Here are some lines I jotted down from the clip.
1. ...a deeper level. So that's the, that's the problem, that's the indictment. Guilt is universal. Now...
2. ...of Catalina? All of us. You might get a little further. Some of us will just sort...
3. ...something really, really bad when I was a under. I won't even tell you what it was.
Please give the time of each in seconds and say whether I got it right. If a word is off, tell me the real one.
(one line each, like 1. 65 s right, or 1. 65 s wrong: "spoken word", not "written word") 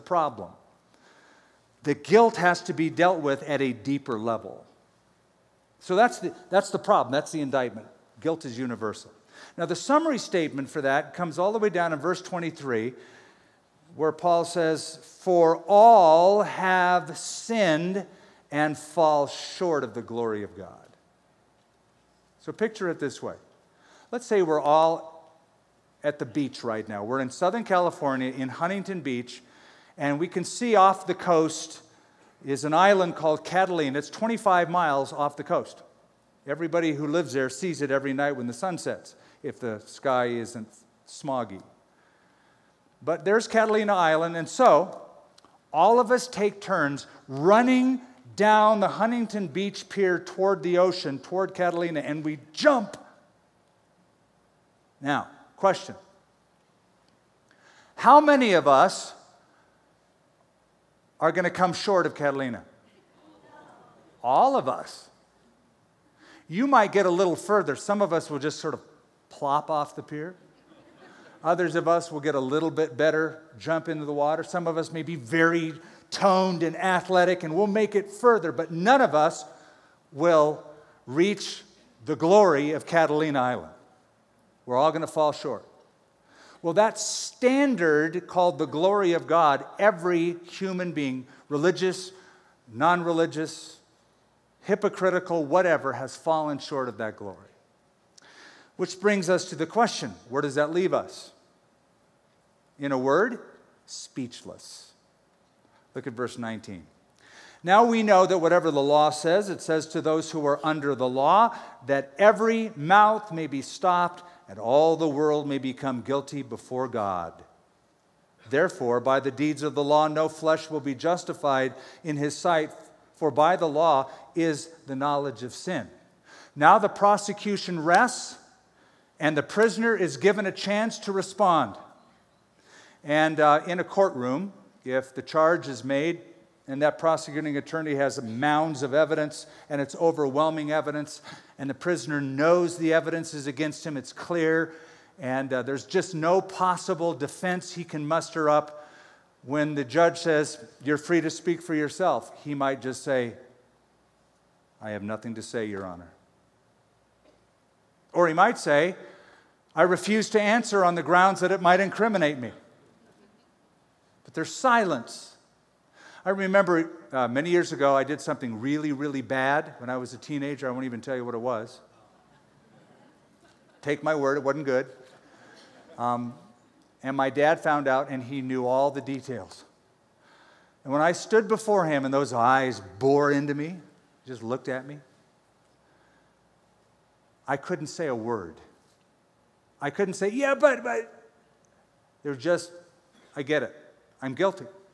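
1. 3 s right
2. 62 s right
3. 168 s wrong: "teenager", not "under".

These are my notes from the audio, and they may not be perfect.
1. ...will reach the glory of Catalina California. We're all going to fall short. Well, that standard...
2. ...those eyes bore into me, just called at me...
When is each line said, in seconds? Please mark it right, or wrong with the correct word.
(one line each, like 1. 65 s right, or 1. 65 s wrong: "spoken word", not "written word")
1. 80 s wrong: "Island", not "California"
2. 182 s wrong: "looked", not "called".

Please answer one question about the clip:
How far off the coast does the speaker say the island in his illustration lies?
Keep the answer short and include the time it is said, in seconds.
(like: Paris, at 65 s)
25 miles, at 34 s.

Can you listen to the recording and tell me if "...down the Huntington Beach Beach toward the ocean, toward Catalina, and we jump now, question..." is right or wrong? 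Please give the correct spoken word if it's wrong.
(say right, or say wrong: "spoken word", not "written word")
wrong: "Pier", not "Beach".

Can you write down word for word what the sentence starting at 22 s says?
So picture it this way Let's say we're all at the beach right now.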